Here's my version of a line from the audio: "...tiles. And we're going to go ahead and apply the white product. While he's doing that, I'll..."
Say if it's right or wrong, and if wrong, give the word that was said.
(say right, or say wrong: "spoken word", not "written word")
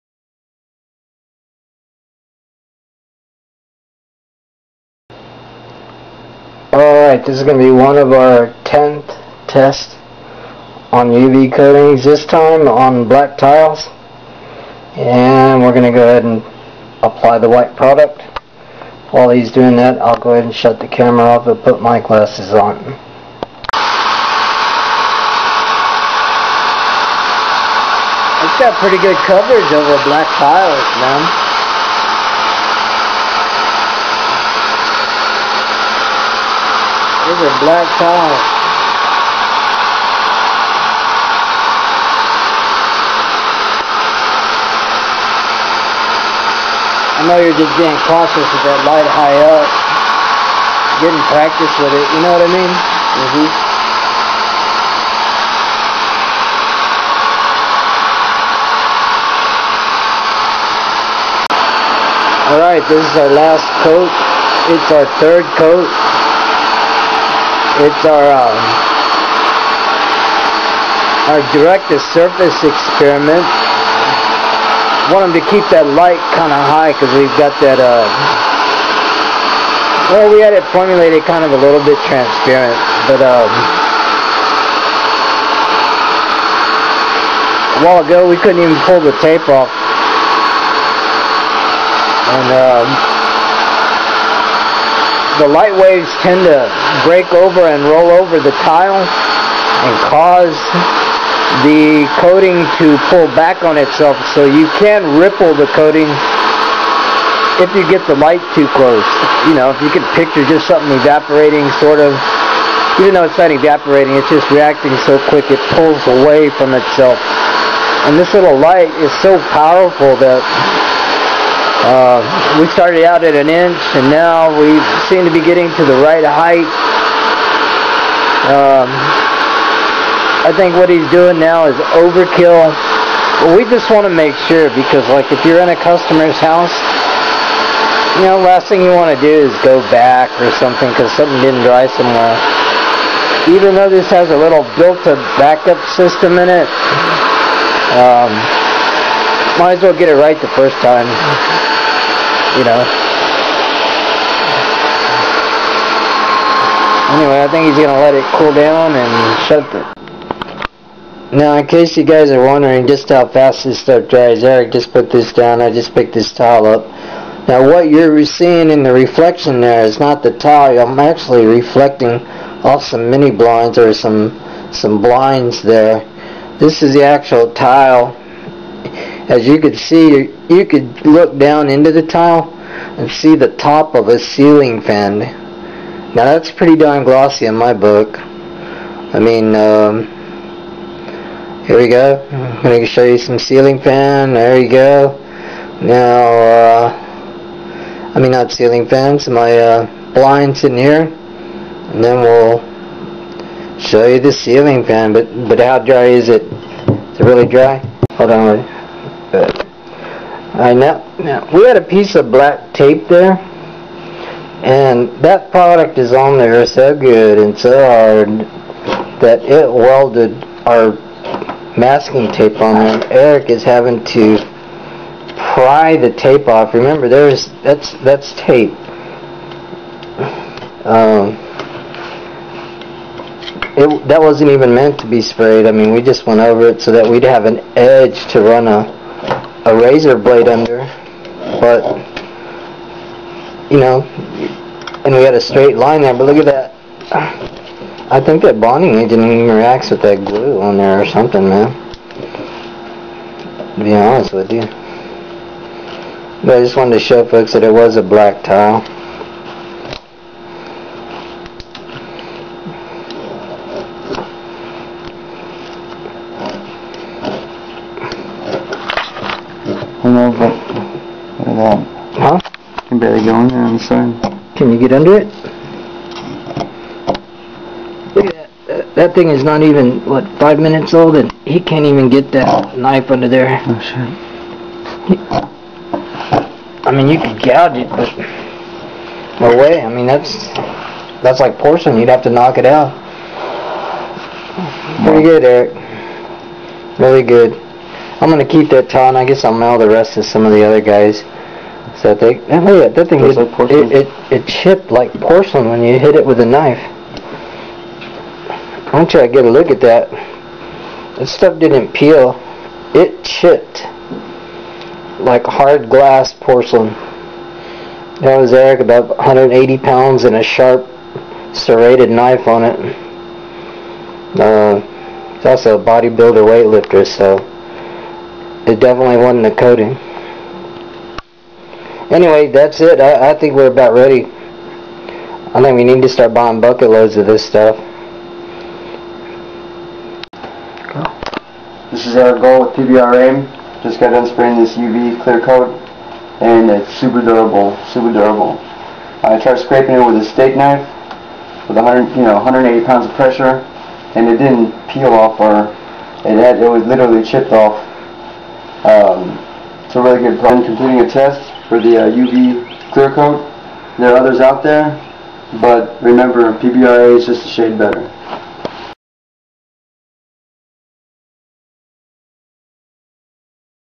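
right.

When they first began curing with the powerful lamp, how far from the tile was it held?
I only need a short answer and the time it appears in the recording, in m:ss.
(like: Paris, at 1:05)
an inch, at 2:03.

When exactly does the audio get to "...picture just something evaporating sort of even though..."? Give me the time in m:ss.
1:50.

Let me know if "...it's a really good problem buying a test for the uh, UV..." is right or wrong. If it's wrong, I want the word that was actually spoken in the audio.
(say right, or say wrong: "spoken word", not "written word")
wrong: "completing", not "buying".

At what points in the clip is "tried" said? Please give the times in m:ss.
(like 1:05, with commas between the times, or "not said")
5:49.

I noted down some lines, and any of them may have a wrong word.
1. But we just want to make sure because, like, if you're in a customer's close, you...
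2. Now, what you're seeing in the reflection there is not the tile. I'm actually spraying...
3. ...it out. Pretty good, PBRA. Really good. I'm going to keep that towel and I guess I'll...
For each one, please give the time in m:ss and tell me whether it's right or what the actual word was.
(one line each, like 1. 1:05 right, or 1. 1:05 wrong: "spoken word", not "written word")
1. 2:13 wrong: "house", not "close"
2. 2:47 wrong: "reflecting", not "spraying"
3. 4:52 wrong: "Eric", not "PBRA".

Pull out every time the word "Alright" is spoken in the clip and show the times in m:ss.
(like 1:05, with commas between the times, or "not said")
0:07, 1:02, 3:30.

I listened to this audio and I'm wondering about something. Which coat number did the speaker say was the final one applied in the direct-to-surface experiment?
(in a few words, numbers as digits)
third.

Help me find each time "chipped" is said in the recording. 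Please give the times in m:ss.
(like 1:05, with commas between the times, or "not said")
5:04, 5:13, 5:57.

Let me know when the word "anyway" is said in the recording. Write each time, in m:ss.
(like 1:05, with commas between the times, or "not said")
2:37, 5:32.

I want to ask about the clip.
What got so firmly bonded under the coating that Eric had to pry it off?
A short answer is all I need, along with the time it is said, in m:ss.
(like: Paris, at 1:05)
masking tape, at 3:41.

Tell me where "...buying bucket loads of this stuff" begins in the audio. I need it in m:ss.
5:36.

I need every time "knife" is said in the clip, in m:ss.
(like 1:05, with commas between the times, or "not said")
4:42, 5:06, 5:22, 5:50.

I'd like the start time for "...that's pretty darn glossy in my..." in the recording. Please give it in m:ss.
3:06.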